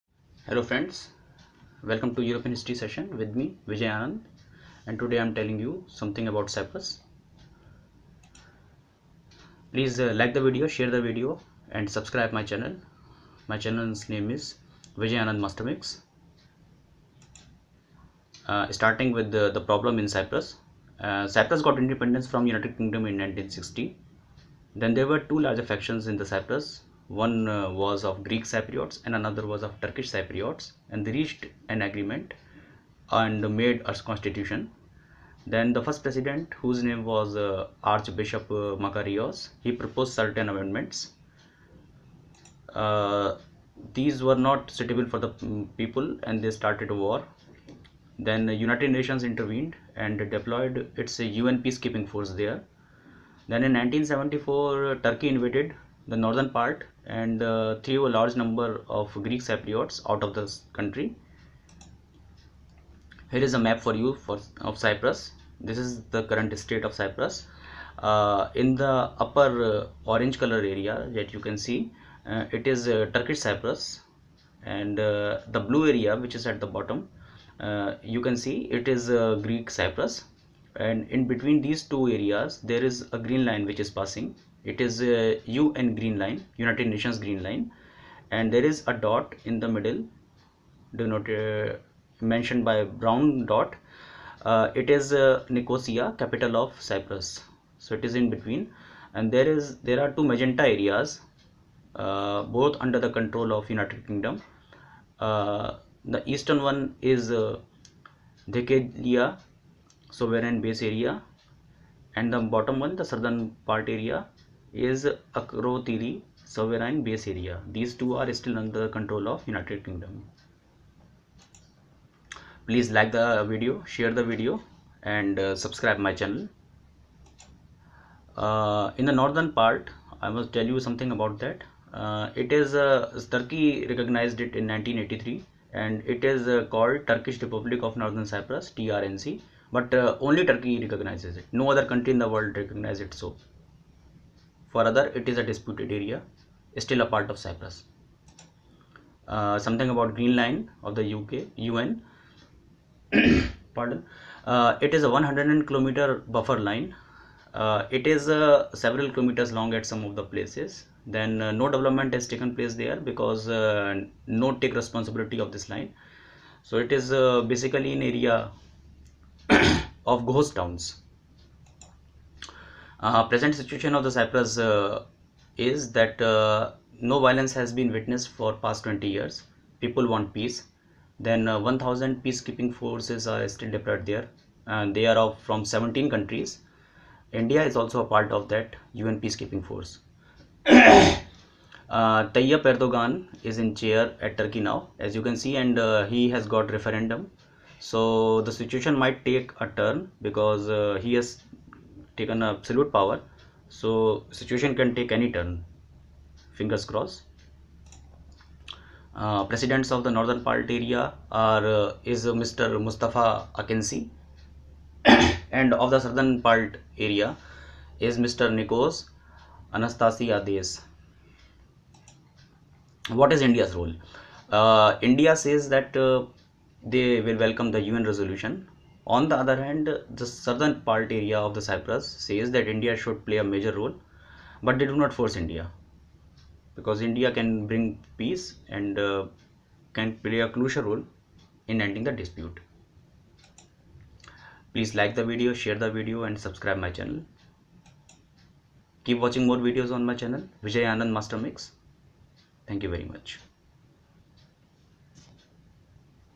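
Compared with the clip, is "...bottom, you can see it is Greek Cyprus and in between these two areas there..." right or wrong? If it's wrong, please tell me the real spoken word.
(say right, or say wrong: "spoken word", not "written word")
right.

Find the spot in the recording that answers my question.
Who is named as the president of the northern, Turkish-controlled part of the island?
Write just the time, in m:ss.
3:32.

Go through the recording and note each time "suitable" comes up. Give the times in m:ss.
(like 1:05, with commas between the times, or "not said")
0:44.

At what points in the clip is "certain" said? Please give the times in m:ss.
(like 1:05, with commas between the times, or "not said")
0:40.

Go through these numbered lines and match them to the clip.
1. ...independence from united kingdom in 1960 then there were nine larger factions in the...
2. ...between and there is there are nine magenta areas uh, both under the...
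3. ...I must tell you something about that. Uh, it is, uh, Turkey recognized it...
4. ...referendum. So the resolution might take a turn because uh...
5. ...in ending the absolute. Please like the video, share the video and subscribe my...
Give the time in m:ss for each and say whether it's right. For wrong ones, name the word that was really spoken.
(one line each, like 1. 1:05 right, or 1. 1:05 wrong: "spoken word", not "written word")
1. 0:21 wrong: "two", not "nine"
2. 1:38 wrong: "two", not "nine"
3. 2:10 right
4. 3:16 wrong: "situation", not "resolution"
5. 4:01 wrong: "dispute", not "absolute".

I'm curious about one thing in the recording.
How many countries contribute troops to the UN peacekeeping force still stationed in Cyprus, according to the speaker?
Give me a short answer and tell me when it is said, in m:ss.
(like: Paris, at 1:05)
17, at 3:05.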